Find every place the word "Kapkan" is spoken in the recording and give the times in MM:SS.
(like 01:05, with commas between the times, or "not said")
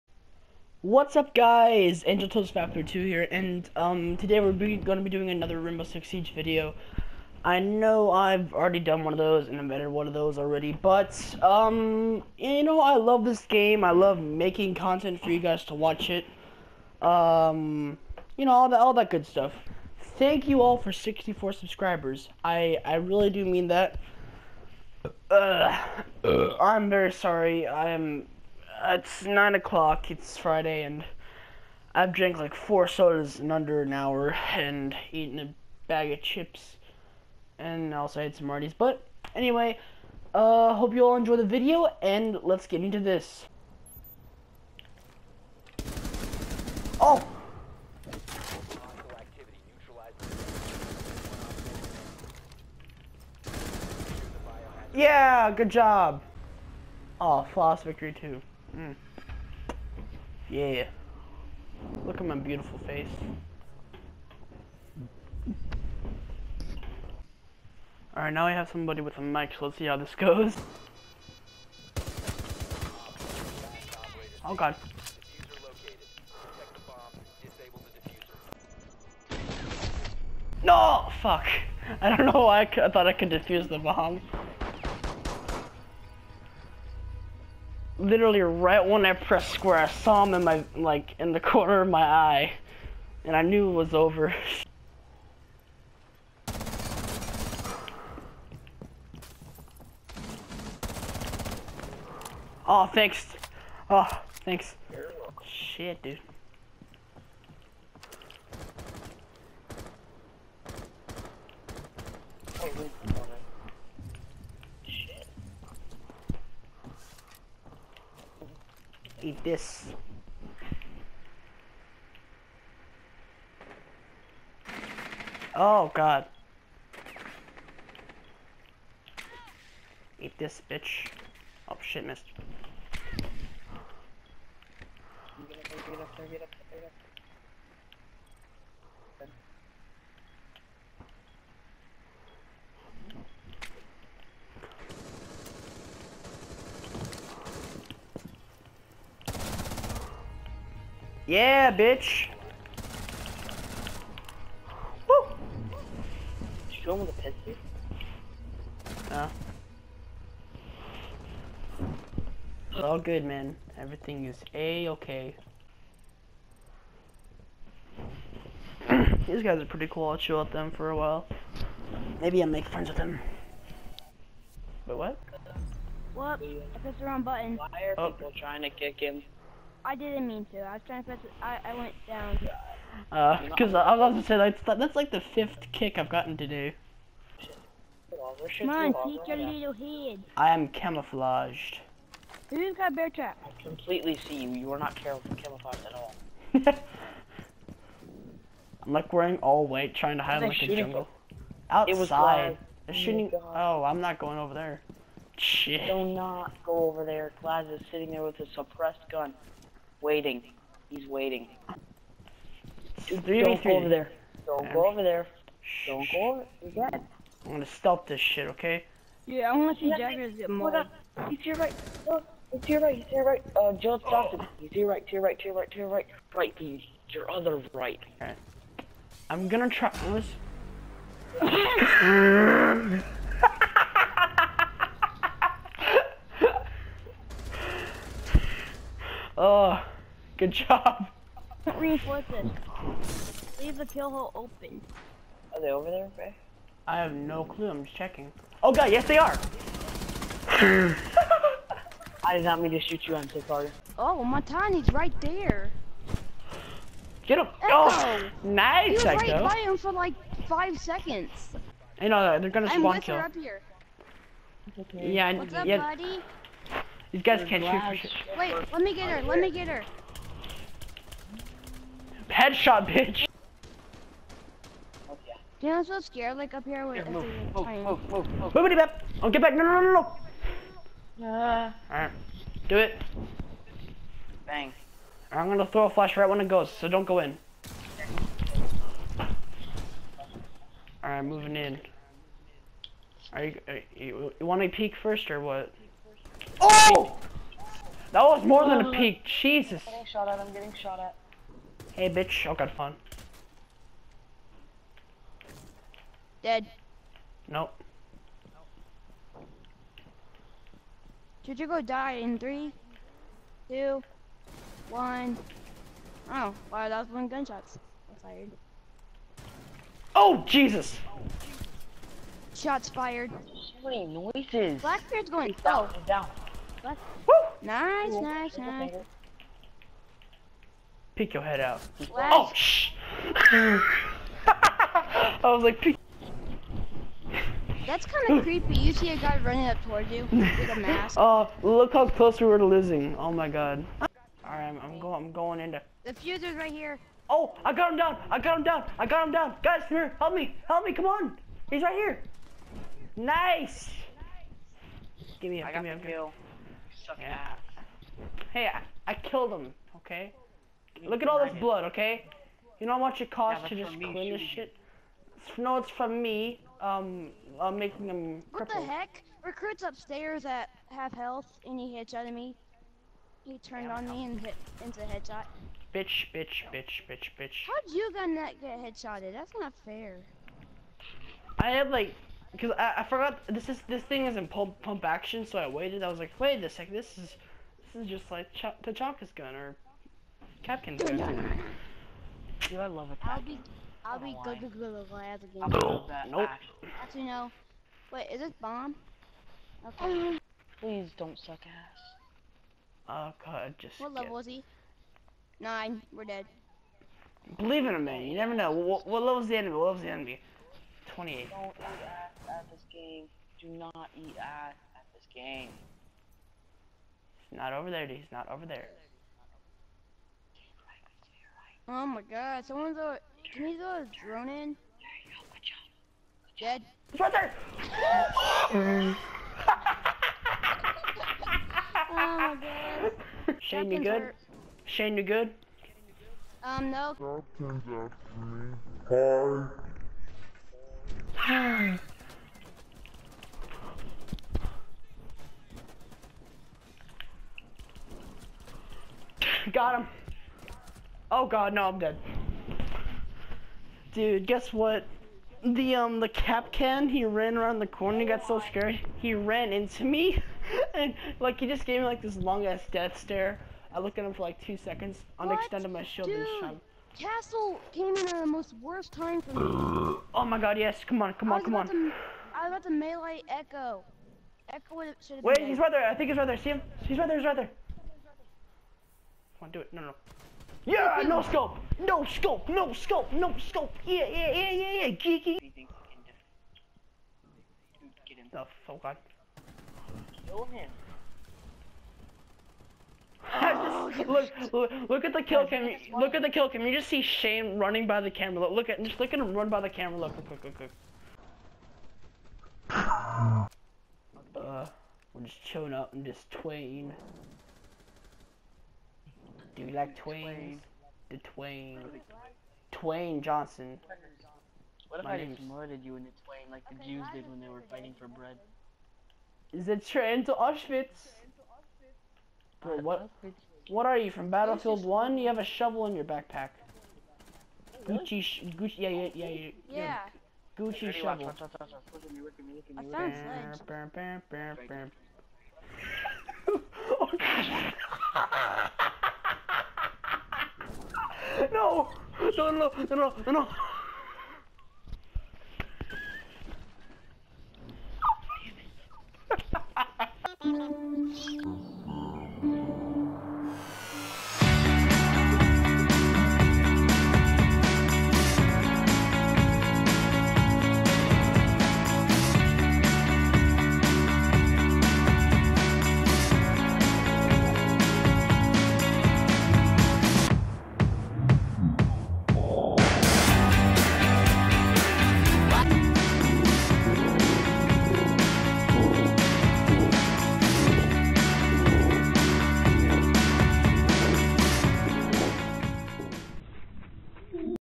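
06:30, 07:36.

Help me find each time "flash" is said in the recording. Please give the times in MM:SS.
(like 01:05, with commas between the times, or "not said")
04:45, 05:31.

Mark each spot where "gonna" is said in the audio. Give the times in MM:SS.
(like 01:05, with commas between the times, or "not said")
03:37, 03:49, 04:22, 04:45.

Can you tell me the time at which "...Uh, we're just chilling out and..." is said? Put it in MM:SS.
08:24.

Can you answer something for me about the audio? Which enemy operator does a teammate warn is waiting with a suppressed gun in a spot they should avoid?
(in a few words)
Glaz.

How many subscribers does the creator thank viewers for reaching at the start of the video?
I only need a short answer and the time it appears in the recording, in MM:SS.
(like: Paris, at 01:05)
64, at 00:20.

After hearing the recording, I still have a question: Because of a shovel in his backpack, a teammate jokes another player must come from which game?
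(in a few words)
Battlefield One.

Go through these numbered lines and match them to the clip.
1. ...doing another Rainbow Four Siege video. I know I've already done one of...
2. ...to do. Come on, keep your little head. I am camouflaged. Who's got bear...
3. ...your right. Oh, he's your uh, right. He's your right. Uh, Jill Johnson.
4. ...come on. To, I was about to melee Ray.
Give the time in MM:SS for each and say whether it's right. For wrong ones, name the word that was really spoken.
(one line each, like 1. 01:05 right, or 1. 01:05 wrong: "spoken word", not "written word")
1. 00:05 wrong: "Six", not "Four"
2. 03:06 right
3. 03:41 right
4. 07:51 wrong: "Echo", not "Ray".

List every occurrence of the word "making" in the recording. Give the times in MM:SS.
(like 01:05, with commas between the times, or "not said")
00:14, 06:07.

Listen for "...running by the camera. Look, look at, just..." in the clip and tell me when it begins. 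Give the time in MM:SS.
08:17.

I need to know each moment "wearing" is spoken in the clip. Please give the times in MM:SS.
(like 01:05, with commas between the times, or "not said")
03:19.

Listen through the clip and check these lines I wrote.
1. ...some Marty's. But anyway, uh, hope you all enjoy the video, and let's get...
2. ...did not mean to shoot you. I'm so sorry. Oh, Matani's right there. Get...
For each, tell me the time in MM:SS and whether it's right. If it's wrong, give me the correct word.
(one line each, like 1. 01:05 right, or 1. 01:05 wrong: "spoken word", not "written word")
1. 00:38 right
2. 04:12 right.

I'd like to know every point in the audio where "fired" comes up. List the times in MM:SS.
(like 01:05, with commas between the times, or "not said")
05:18, 05:22.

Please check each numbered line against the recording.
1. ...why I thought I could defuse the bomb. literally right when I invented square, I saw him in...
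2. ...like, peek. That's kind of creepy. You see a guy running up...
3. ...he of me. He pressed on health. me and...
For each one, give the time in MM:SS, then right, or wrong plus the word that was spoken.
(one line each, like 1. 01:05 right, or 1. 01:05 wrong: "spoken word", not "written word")
1. 01:22 wrong: "pressed", not "invented"
2. 05:35 right
3. 06:11 wrong: "turned", not "pressed".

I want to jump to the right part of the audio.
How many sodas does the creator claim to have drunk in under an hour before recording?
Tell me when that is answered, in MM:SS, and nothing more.
00:32.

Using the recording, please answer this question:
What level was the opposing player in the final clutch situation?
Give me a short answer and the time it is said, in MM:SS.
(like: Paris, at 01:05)
28, at 06:51.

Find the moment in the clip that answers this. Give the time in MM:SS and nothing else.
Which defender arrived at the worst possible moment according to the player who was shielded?
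07:47.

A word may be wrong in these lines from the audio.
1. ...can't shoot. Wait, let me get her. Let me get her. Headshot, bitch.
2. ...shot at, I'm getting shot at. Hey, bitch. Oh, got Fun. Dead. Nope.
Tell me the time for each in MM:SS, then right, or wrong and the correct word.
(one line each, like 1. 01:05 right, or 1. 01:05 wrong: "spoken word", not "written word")
1. 04:27 right
2. 05:00 right.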